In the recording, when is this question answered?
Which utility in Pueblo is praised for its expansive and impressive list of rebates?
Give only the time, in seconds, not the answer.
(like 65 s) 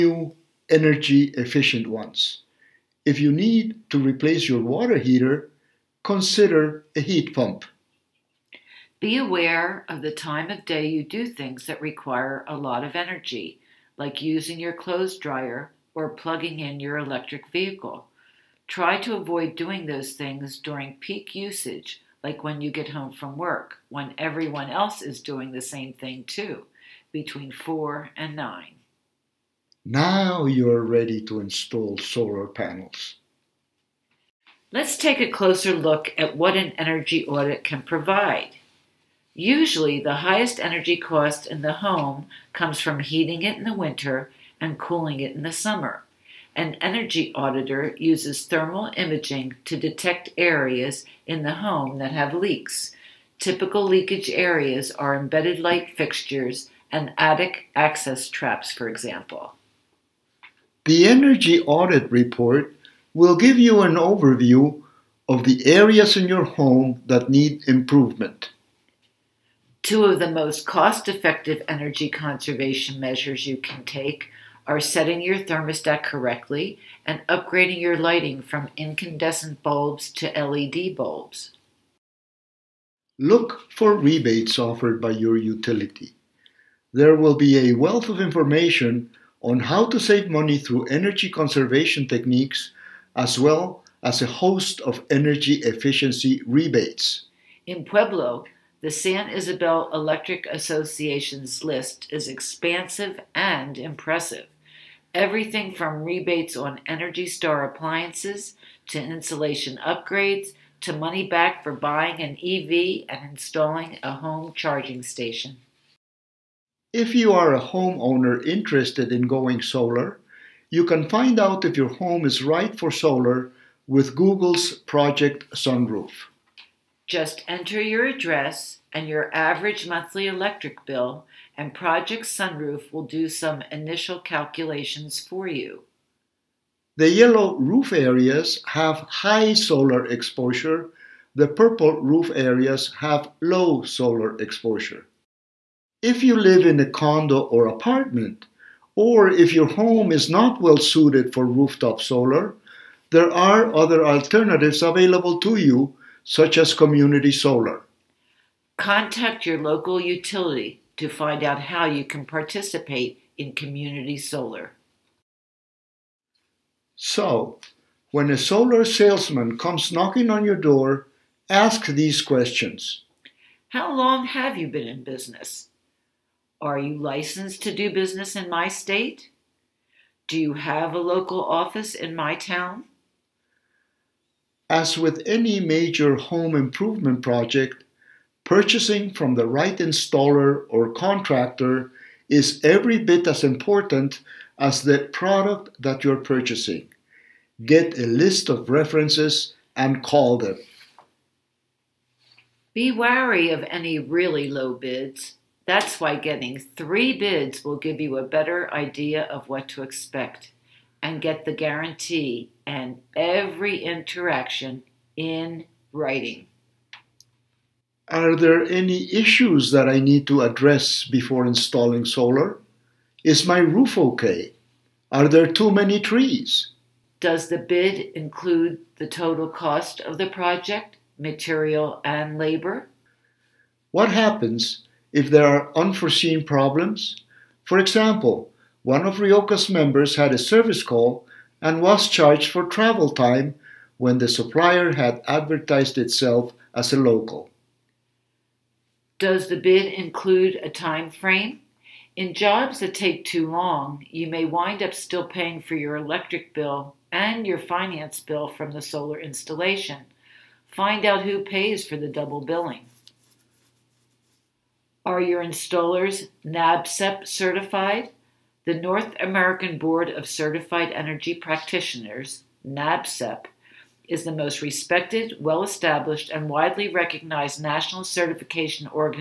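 98 s.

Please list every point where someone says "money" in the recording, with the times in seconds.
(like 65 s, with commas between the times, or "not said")
90 s, 110 s.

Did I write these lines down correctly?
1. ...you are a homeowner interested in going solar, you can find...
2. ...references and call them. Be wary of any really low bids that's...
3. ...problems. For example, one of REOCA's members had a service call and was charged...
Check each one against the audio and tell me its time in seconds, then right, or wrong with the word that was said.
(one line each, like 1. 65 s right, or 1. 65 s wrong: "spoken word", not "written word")
1. 117 s right
2. 198 s right
3. 236 s right.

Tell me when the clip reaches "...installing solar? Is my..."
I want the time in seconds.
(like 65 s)
221 s.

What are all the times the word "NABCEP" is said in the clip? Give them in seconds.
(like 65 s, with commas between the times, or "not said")
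266 s, 272 s.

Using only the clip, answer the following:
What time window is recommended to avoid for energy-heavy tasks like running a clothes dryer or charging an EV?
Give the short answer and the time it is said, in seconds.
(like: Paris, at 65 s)
4 to 9, at 27 s.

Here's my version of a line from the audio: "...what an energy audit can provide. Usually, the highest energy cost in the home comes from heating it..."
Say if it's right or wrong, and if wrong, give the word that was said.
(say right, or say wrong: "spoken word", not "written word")
right.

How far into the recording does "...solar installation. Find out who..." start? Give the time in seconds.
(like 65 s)
258 s.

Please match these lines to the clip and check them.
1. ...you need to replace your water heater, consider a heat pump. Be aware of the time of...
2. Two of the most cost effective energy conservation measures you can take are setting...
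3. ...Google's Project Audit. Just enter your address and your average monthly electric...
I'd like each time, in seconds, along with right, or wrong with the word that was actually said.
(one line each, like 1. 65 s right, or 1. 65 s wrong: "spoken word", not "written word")
1. 3 s right
2. 69 s right
3. 124 s wrong: "Sunroof", not "Audit".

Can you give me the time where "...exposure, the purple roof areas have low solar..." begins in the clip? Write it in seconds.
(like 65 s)
140 s.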